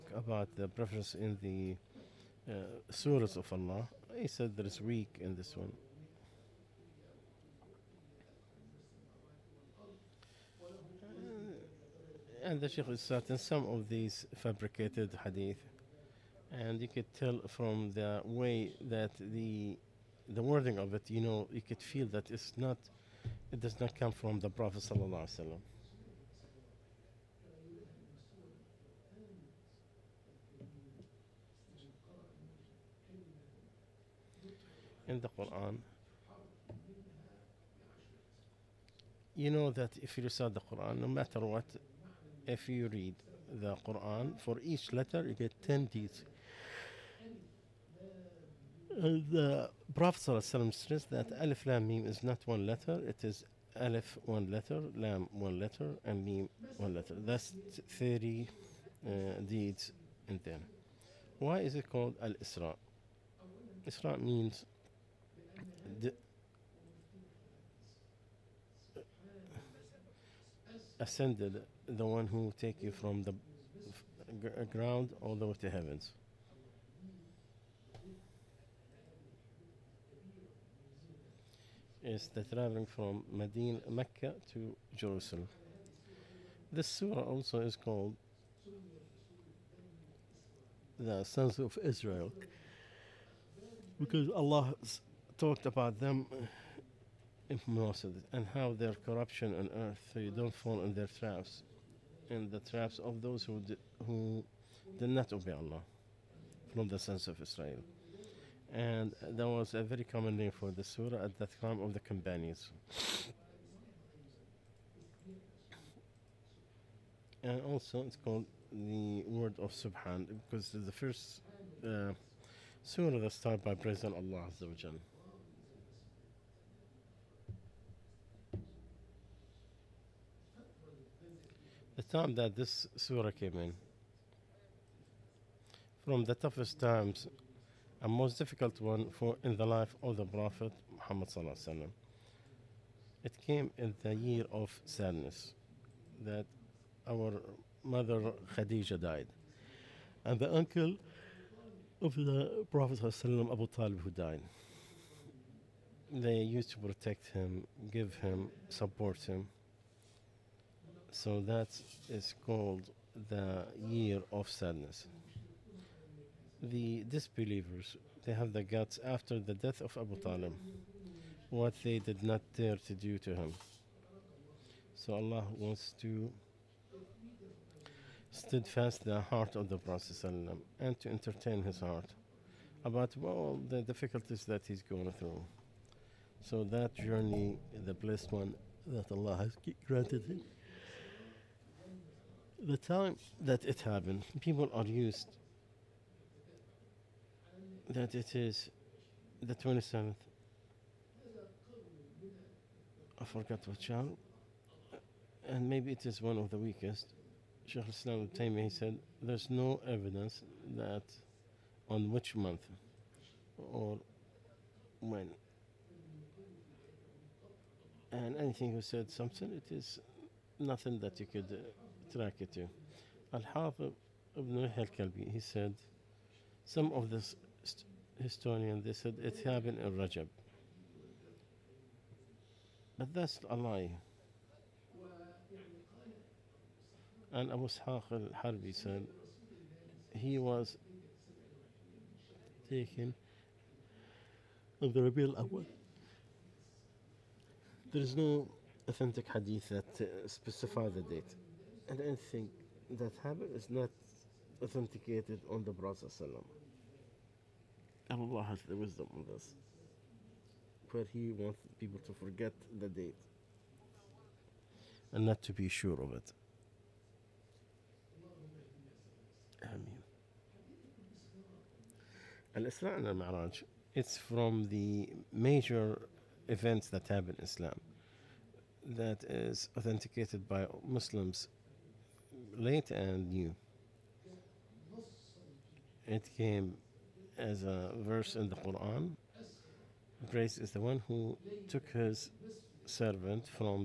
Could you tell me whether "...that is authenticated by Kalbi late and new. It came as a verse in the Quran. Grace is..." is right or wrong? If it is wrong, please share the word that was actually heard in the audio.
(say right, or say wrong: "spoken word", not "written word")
wrong: "Muslims", not "Kalbi".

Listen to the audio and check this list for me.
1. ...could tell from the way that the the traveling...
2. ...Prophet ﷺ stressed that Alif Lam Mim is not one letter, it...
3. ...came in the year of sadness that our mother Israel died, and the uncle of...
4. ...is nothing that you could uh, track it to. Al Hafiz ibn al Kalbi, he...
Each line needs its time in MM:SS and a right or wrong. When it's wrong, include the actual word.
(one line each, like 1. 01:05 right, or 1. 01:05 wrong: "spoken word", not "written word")
1. 00:16 wrong: "wording", not "traveling"
2. 00:49 right
3. 02:23 wrong: "Khadija", not "Israel"
4. 03:39 right.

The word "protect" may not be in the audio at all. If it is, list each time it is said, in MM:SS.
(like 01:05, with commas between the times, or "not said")
02:36.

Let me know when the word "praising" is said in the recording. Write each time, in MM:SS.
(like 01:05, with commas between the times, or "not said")
02:03.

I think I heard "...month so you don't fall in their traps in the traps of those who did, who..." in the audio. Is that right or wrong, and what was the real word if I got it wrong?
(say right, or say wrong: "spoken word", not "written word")
wrong: "earth", not "month".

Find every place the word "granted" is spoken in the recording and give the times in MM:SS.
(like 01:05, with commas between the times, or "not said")
03:09.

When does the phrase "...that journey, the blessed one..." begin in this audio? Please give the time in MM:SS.
03:06.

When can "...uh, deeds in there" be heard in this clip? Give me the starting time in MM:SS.
00:59.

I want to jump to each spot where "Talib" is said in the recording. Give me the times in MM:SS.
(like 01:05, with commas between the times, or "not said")
02:33, 02:50.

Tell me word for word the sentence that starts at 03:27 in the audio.
Sheikh Islam Taymi said there's no evidence that on which month or when.